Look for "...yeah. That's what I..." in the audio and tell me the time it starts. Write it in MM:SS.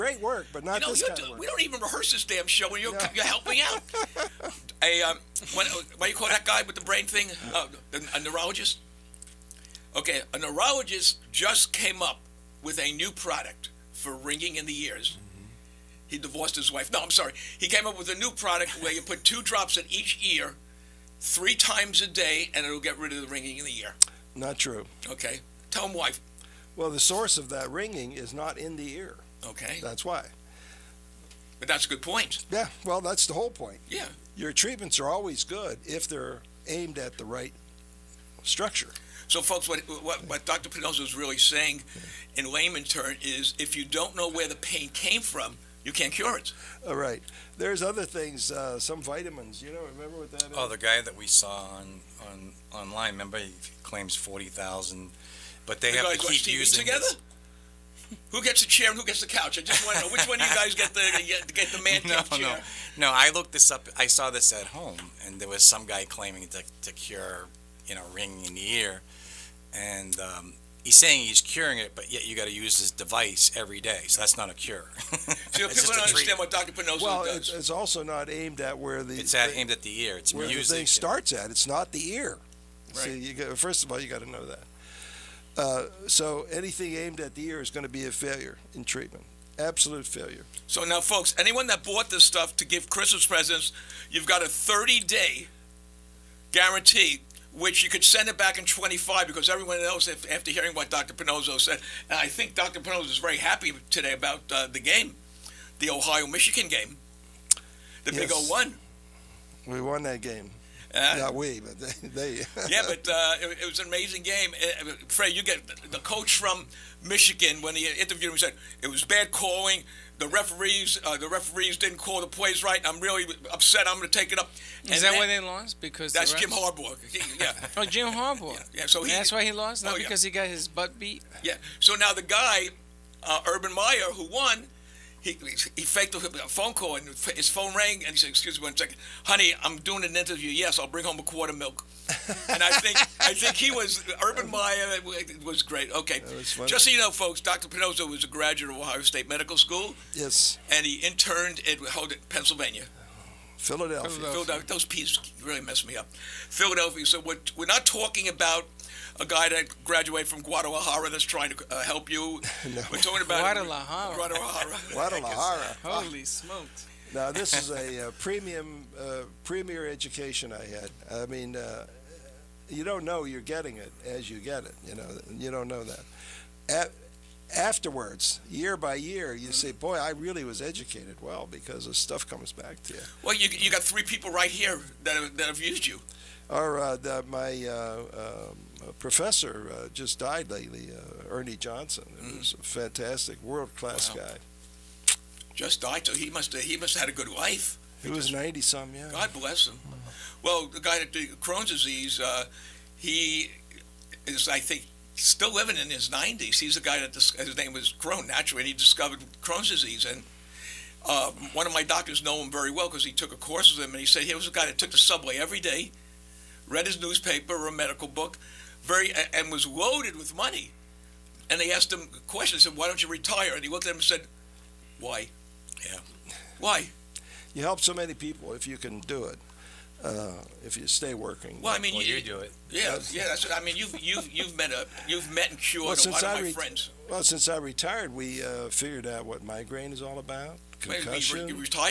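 03:53.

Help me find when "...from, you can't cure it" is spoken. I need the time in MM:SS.
00:45.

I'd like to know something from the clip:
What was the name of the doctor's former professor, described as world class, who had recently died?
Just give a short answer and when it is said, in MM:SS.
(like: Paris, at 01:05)
Ernie Johnson, at 03:11.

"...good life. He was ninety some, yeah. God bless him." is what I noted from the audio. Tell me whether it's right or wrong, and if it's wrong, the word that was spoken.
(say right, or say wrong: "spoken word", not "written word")
right.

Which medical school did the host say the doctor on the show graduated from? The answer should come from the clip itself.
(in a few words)
Ohio State Medical School.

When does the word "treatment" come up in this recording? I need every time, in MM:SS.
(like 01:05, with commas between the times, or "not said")
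00:34, 01:16, 01:28.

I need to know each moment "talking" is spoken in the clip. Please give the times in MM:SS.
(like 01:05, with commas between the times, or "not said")
02:37, 02:42.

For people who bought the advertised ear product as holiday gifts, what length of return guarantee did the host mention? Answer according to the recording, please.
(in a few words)
30 day.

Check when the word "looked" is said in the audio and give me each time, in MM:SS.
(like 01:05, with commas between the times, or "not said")
01:03, 03:43.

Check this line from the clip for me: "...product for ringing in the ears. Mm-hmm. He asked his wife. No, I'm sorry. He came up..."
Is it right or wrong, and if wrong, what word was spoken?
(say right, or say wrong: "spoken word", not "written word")
wrong: "divorced", not "asked".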